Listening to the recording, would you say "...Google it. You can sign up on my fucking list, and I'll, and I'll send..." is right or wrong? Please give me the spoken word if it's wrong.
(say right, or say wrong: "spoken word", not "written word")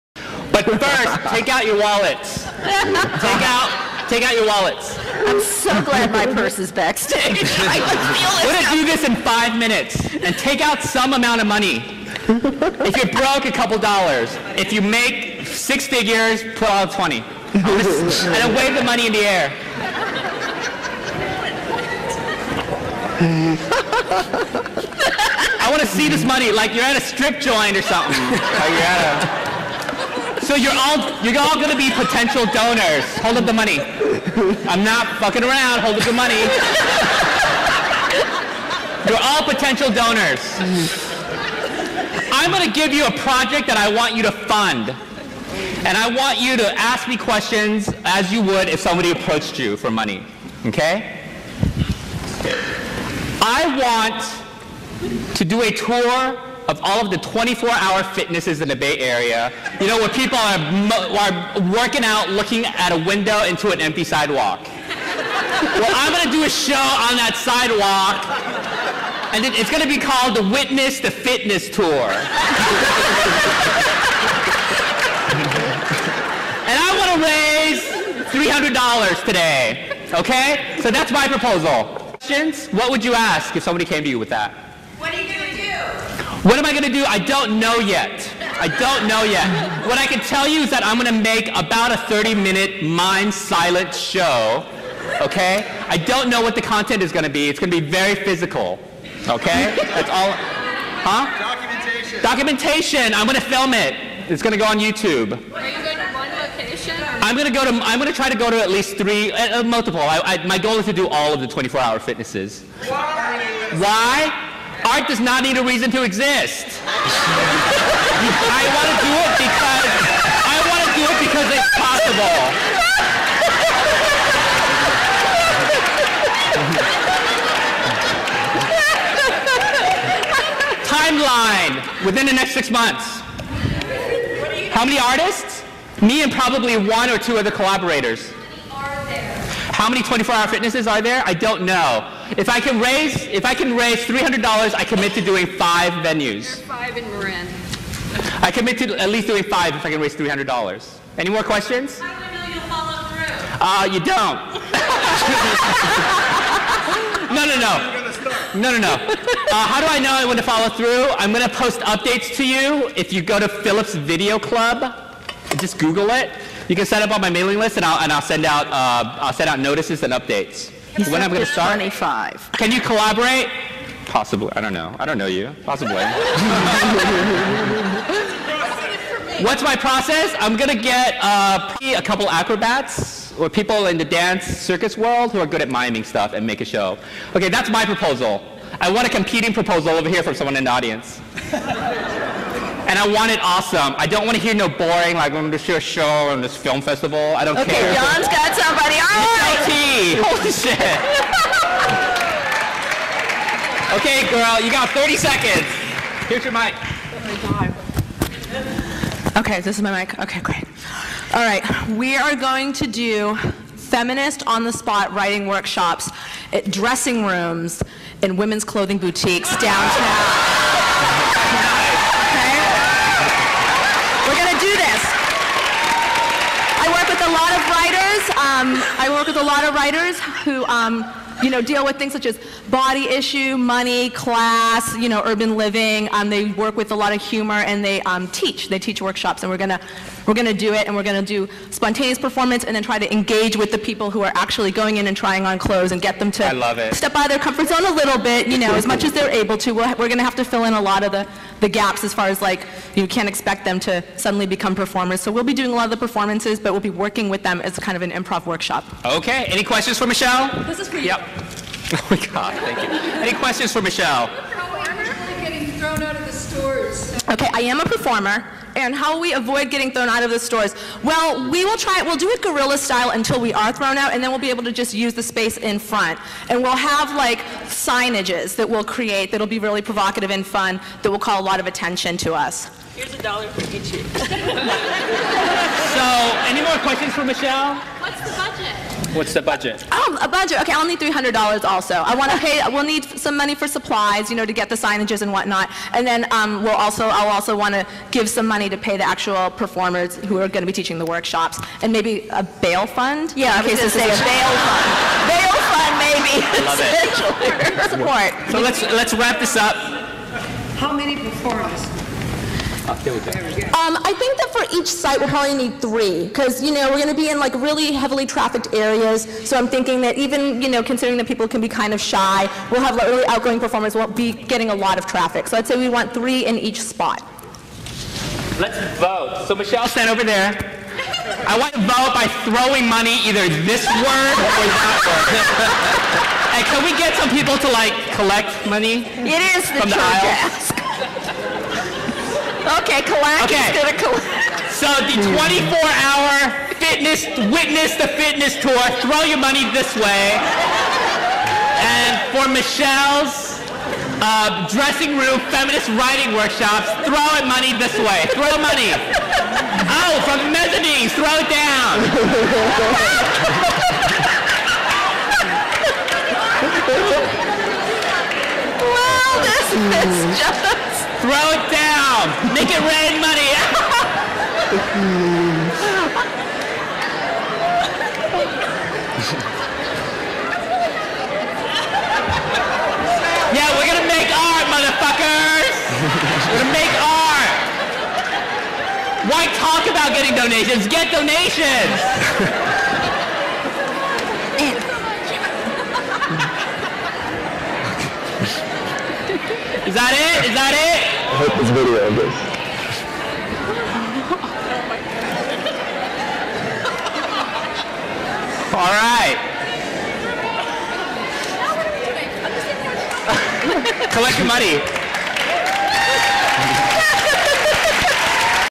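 wrong: "mailing", not "fucking".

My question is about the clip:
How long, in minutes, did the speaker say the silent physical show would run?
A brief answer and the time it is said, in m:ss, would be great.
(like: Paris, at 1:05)
30, at 1:31.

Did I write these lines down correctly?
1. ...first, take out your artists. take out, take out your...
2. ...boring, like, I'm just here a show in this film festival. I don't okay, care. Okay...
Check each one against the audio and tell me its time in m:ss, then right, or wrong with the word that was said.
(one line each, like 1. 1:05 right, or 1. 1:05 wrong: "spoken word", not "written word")
1. 0:00 wrong: "wallets", not "artists"
2. 3:14 right.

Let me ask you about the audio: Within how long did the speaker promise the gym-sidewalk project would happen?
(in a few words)
Six months.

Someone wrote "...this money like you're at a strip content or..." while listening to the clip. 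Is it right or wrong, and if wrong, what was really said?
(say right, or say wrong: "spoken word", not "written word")
wrong: "joint", not "content".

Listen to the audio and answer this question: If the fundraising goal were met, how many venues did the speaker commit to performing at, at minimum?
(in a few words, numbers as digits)
5.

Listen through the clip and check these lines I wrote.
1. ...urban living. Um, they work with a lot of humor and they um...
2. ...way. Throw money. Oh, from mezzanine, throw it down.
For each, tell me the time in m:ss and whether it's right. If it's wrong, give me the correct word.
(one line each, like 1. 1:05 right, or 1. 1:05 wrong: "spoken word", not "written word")
1. 3:55 right
2. 5:57 right.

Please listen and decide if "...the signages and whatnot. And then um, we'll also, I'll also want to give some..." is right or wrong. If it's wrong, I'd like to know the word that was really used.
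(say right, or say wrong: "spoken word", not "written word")
right.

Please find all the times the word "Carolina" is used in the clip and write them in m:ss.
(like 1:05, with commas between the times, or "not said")
not said.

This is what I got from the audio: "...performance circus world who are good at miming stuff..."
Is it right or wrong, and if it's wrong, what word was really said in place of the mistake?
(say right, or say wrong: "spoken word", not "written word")
wrong: "dance", not "performance".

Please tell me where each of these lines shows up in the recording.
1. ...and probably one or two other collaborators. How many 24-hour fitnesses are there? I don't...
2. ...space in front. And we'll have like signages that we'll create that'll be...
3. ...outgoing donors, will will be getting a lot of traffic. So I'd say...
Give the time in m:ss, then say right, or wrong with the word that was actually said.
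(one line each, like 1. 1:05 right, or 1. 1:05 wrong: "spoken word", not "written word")
1. 2:16 right
2. 4:35 right
3. 5:23 wrong: "performers", not "donors".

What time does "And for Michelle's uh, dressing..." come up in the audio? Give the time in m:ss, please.
5:51.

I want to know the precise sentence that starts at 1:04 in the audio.
well, I'm going to do a show on that sidewalk, and it, it's going to be called the Witness the Fitness Tour.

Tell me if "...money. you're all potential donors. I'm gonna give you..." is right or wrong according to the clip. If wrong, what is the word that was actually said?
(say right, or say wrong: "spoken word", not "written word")
right.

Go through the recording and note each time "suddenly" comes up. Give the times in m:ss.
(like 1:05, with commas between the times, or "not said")
4:14.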